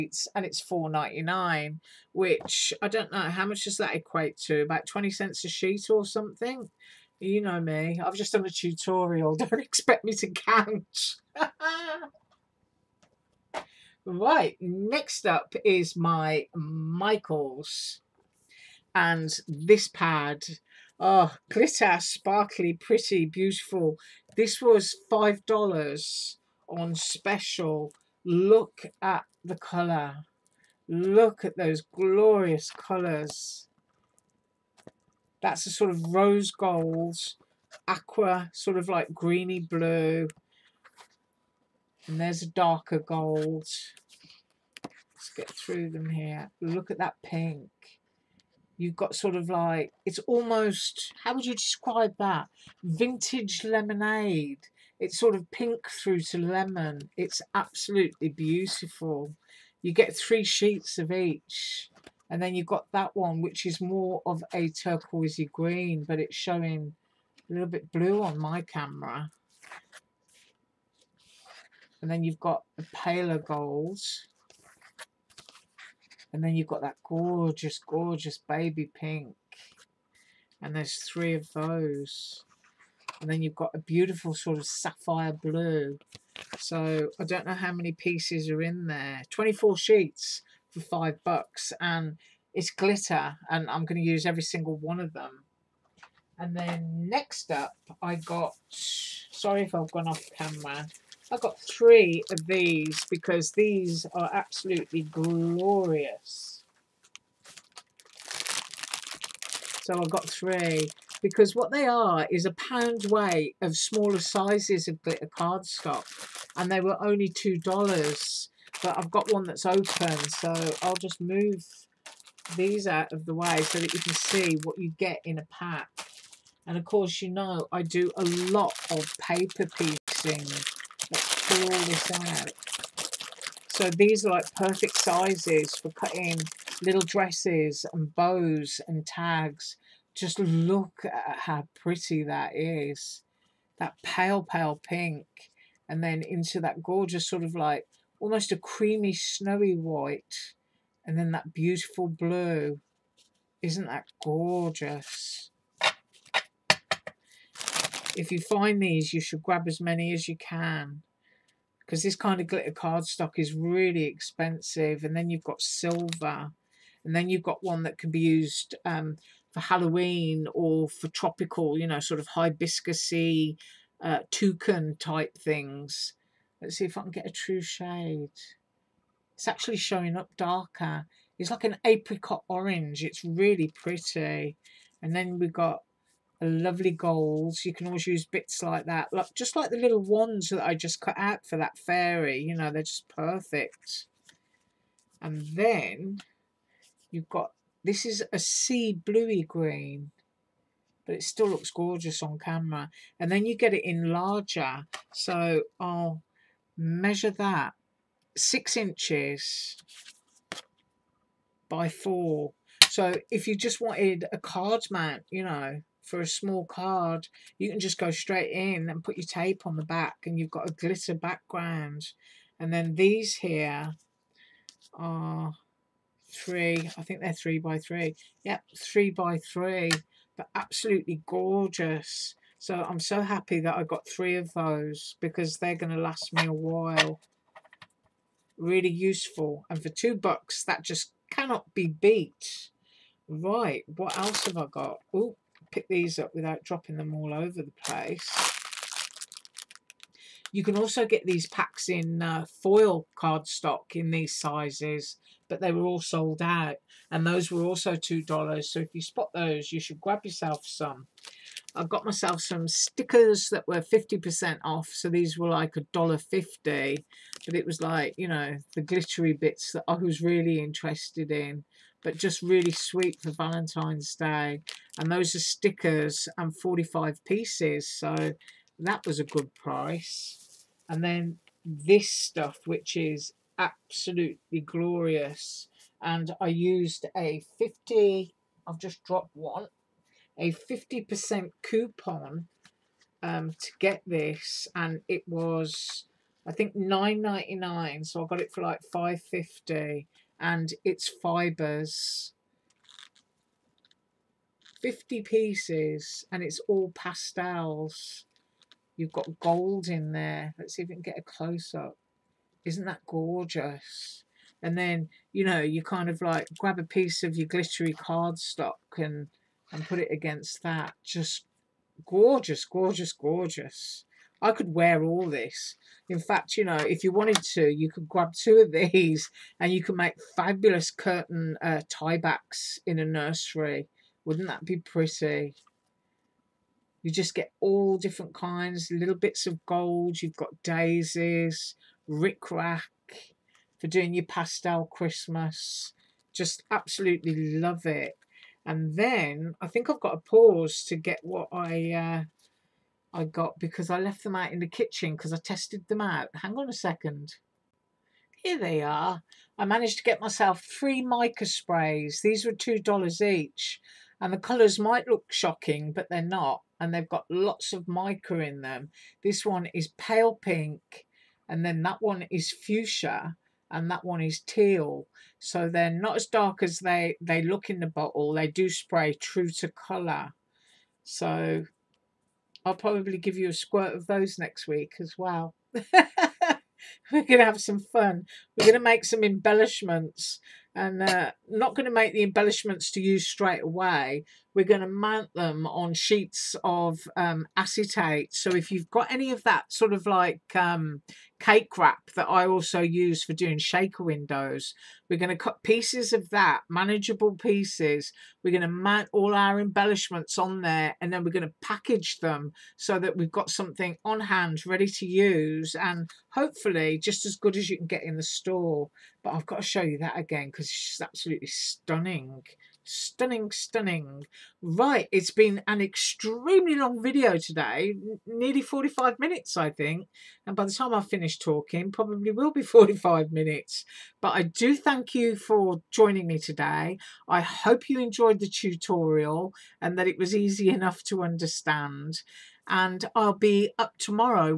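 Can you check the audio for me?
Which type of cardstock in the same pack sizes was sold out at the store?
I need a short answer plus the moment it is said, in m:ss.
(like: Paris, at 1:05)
foil cardstock, at 4:12.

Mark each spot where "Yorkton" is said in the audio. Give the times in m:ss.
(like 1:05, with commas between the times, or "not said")
not said.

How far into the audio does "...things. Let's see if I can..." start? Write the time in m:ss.
2:55.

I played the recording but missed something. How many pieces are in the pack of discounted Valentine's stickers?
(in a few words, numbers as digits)
45.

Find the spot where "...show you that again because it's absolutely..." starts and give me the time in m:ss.
6:59.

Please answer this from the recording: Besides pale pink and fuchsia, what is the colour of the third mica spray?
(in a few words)
teal.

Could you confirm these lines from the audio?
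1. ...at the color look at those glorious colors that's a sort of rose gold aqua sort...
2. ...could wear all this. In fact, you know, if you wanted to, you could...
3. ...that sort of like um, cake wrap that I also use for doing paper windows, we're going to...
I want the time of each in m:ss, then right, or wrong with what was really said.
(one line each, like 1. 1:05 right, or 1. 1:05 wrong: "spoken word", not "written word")
1. 0:28 right
2. 5:24 right
3. 6:39 wrong: "shaker", not "paper".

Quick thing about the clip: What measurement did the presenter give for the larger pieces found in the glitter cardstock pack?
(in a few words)
6 inches by 4.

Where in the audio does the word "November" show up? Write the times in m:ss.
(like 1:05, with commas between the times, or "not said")
not said.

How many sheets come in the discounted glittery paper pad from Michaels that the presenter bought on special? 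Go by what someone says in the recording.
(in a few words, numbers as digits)
24.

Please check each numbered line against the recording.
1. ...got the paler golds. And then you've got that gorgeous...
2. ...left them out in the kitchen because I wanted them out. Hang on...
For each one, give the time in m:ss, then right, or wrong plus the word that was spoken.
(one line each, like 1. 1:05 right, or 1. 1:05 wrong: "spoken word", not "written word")
1. 1:12 right
2. 5:53 wrong: "tested", not "wanted".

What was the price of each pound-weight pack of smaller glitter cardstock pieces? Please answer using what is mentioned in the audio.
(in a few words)
2 dollars.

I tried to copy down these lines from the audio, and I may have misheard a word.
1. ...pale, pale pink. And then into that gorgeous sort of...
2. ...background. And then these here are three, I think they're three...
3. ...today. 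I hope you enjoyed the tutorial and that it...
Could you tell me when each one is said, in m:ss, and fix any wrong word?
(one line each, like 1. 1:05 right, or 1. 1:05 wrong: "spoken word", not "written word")
1. 2:24 right
2. 3:41 right
3. 7:16 right.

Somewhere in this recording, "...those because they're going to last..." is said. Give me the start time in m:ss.
3:54.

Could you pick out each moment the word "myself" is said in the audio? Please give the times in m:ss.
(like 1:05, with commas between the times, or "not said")
4:22, 6:00.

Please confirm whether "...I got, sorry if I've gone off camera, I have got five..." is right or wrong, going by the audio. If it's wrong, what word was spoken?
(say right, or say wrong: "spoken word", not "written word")
wrong: "three", not "five".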